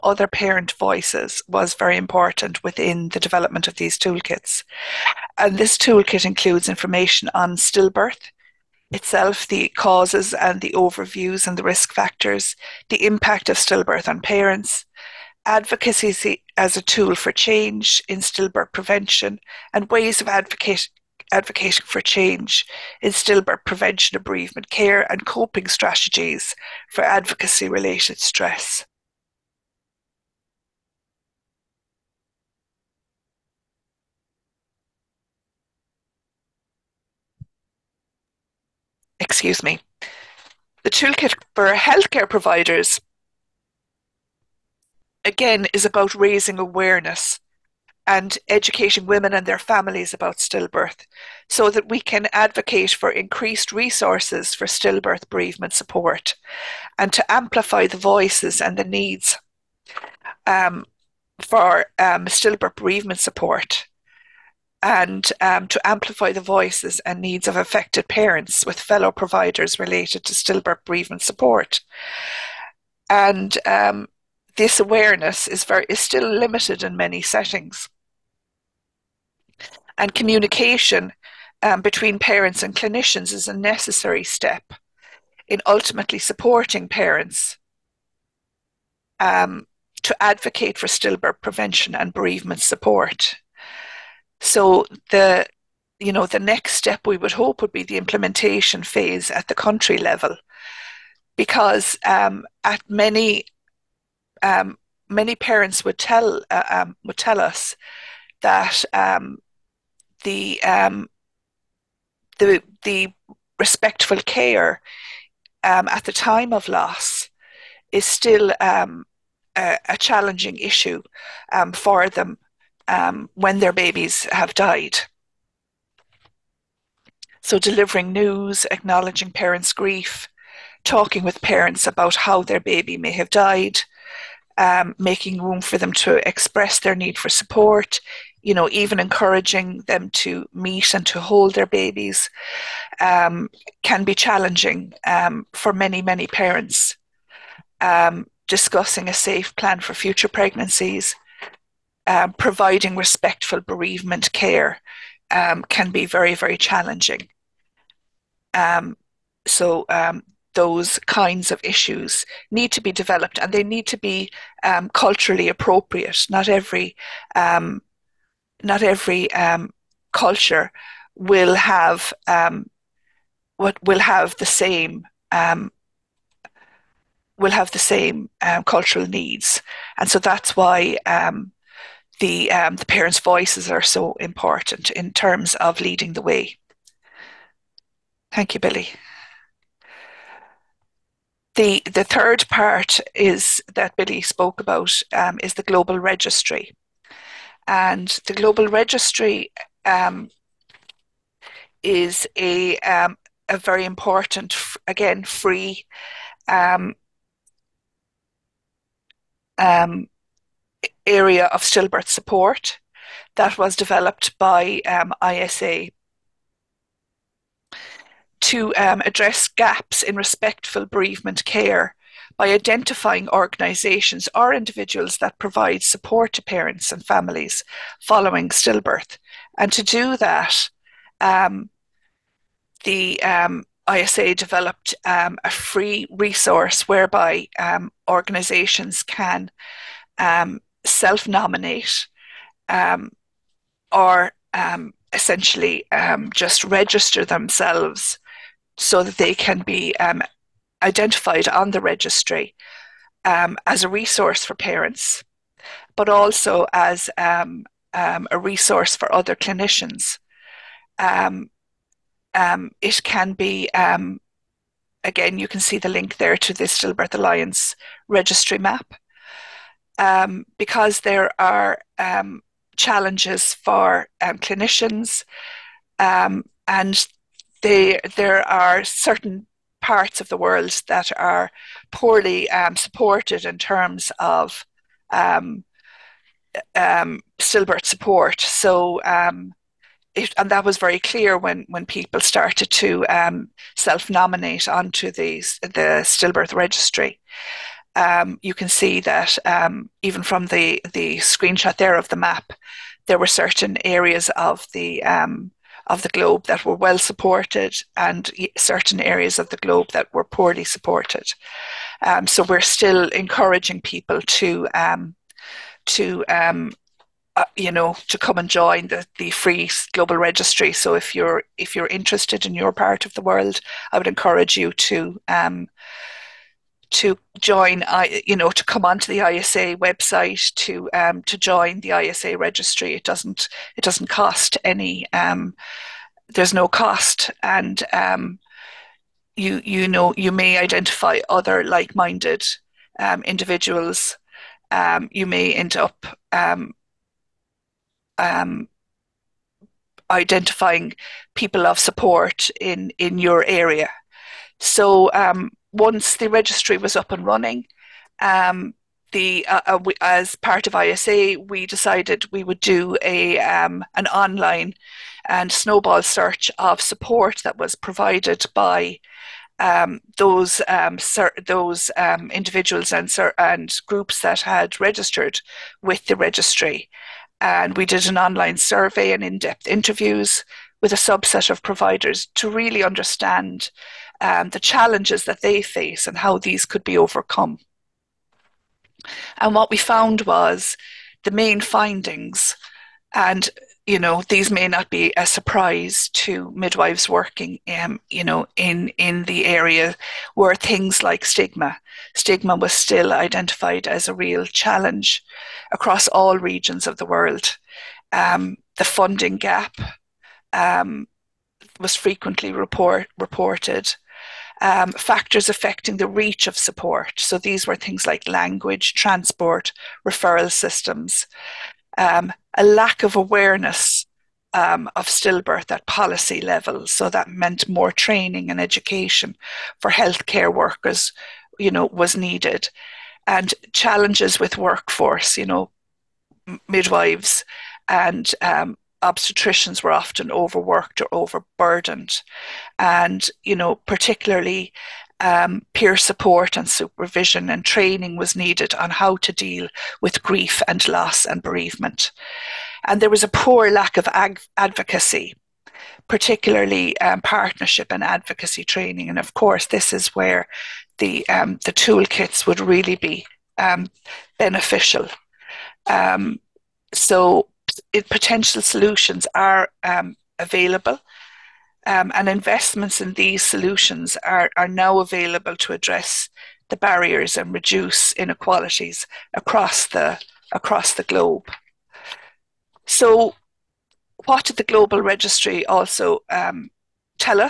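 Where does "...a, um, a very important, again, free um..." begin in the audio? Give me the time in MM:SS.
03:22.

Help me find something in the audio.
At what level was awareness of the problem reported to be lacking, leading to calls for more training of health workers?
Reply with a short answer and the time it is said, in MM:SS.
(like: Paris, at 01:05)
Policy level, at 07:05.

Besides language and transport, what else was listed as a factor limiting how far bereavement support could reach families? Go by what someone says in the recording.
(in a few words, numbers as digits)
Referral systems.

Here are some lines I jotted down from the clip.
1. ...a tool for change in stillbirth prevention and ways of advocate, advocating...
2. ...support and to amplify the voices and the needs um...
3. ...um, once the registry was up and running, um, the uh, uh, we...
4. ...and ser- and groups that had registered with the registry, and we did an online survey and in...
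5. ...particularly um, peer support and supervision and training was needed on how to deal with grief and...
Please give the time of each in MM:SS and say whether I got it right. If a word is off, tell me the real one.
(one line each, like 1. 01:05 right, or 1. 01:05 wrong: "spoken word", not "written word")
1. 00:16 right
2. 00:55 right
3. 05:55 right
4. 06:12 right
5. 07:23 right.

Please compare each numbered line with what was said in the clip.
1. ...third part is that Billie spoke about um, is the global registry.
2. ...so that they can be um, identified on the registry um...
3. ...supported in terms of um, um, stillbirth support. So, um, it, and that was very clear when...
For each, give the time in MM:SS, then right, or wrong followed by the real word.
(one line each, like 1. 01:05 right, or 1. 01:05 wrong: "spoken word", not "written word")
1. 03:12 right
2. 04:08 right
3. 04:42 right.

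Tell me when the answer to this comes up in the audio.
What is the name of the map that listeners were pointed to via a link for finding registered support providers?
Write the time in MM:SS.
04:26.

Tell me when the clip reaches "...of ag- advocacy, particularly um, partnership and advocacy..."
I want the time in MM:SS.
07:33.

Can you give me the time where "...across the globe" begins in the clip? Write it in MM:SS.
08:00.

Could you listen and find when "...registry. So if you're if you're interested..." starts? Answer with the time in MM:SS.
05:20.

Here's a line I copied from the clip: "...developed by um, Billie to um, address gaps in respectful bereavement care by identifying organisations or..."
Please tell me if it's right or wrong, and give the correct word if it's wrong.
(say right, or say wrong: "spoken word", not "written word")
wrong: "ISA", not "Billie".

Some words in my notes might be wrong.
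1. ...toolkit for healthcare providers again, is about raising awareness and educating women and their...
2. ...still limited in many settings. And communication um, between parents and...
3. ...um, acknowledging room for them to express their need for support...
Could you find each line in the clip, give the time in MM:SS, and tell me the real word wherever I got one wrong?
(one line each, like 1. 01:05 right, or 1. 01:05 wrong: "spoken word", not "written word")
1. 00:40 right
2. 01:15 right
3. 02:14 wrong: "making", not "acknowledging".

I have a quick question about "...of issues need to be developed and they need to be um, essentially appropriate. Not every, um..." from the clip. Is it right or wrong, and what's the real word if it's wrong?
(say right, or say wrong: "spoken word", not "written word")
wrong: "culturally", not "essentially".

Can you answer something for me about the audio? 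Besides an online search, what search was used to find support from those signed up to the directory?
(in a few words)
Snowball search.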